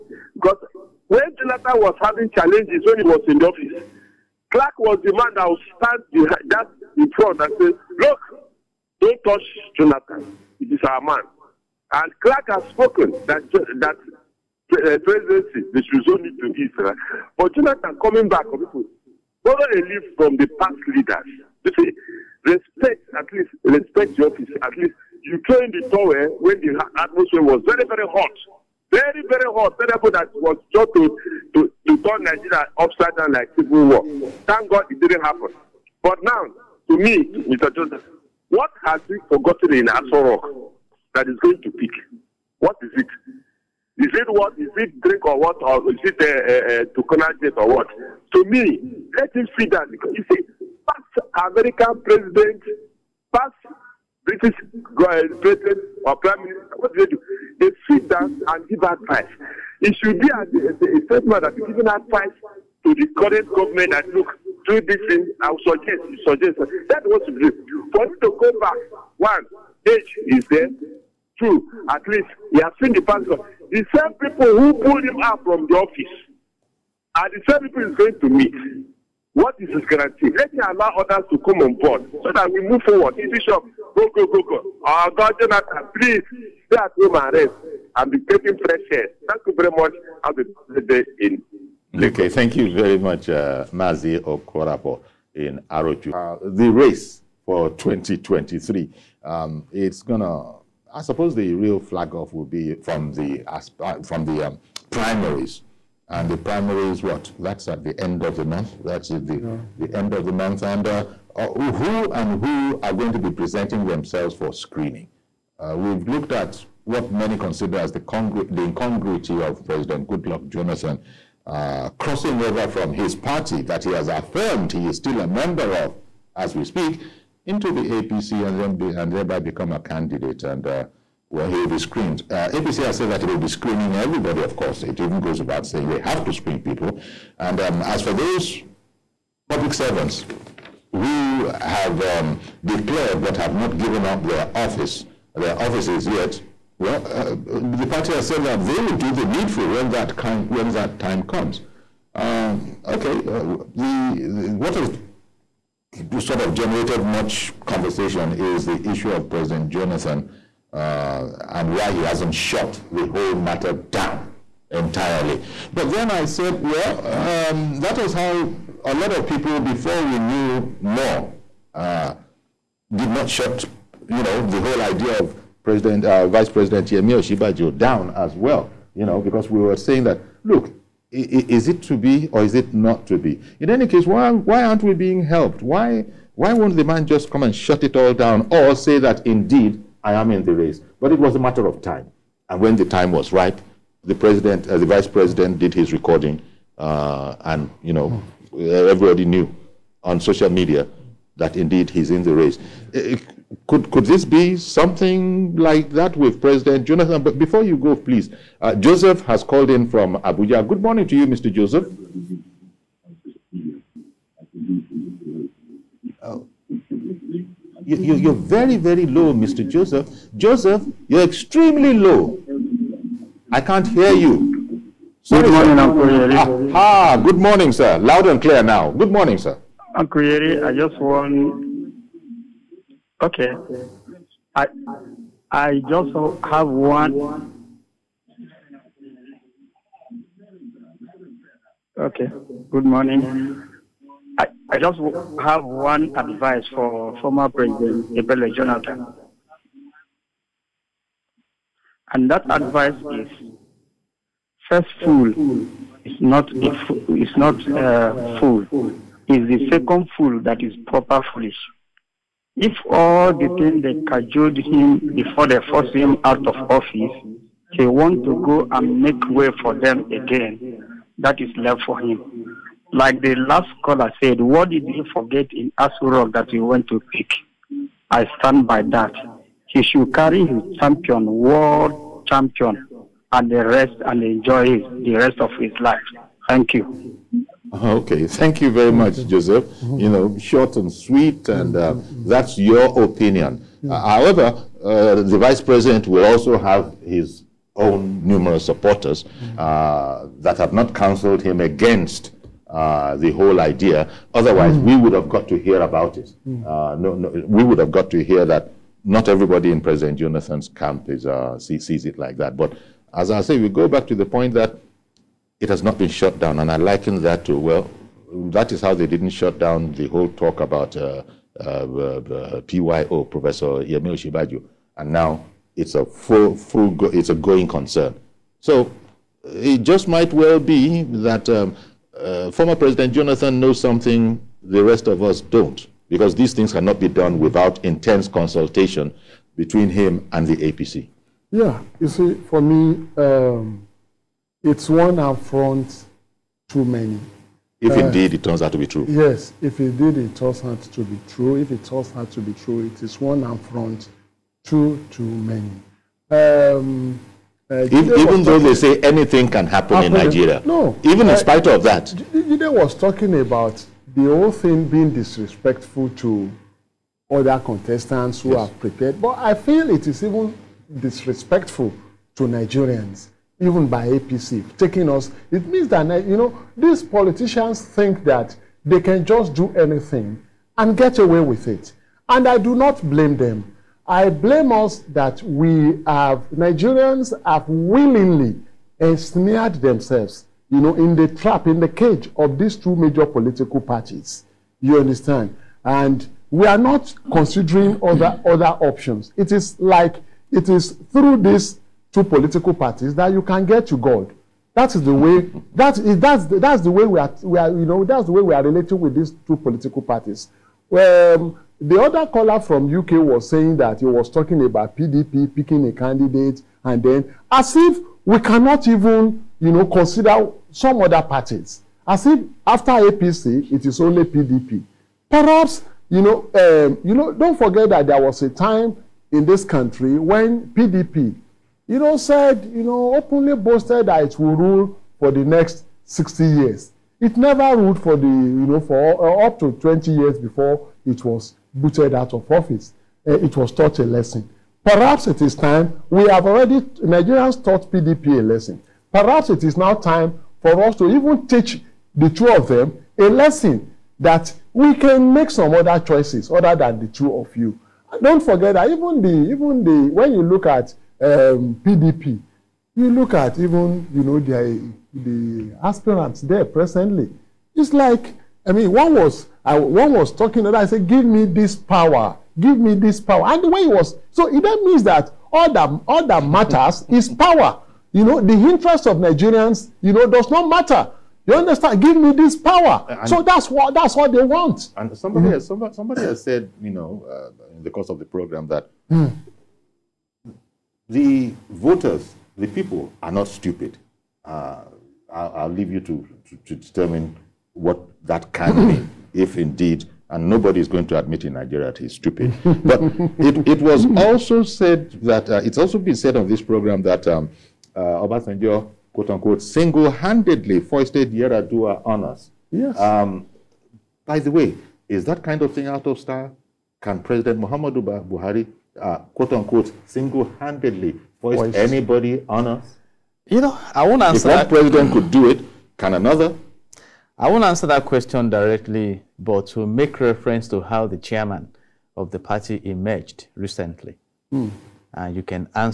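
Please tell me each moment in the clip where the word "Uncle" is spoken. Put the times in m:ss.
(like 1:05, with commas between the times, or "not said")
3:45, 3:49.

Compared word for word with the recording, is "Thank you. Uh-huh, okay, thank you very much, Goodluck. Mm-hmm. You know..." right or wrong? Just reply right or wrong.
wrong.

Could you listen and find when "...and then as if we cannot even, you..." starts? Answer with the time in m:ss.
6:56.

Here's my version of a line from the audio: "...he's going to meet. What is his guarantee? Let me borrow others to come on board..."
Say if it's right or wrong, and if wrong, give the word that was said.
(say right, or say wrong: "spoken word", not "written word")
wrong: "allow", not "borrow".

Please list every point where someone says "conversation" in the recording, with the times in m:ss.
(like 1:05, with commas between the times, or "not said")
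2:37.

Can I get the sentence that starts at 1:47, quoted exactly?
That's at the end of the month.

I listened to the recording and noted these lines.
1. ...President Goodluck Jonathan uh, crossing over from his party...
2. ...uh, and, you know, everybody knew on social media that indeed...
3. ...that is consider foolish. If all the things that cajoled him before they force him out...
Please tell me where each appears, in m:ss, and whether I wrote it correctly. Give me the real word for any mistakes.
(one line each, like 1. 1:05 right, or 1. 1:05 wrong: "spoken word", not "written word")
1. 1:59 right
2. 3:16 right
3. 4:20 wrong: "proper", not "consider".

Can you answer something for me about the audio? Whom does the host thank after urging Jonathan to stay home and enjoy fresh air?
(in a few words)
Mazi Okorapo.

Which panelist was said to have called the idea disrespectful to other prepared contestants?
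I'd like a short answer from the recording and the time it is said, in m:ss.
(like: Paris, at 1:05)
Jide, at 6:02.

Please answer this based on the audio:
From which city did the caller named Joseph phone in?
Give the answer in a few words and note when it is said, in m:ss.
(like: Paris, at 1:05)
Abuja, at 3:30.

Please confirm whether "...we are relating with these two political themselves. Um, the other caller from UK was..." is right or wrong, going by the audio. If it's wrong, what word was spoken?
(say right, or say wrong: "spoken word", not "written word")
wrong: "parties", not "themselves".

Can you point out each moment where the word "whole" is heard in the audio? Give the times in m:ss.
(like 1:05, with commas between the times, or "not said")
2:43, 2:54, 5:03, 5:20, 6:04.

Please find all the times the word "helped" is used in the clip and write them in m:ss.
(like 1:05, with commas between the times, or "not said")
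3:05.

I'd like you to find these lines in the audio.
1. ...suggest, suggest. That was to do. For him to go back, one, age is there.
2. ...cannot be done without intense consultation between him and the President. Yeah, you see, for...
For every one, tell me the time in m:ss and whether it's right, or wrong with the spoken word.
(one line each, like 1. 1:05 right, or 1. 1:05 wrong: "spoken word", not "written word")
1. 1:05 right
2. 5:36 wrong: "APC", not "President".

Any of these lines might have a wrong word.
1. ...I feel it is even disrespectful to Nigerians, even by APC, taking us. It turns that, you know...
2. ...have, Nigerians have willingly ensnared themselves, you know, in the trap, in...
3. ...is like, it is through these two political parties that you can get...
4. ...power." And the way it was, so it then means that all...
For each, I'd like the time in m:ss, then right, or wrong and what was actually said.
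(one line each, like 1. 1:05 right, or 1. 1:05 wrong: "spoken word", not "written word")
1. 6:09 wrong: "means", not "turns"
2. 6:26 right
3. 6:39 right
4. 7:53 right.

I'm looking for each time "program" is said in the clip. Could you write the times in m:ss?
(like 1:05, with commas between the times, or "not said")
8:08, 8:26.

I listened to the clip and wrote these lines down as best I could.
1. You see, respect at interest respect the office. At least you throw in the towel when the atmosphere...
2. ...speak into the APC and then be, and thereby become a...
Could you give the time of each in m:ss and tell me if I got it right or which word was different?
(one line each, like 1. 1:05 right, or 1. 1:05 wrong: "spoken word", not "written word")
1. 0:21 wrong: "least", not "interest"
2. 2:06 right.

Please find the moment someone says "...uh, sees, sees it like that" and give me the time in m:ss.
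5:11.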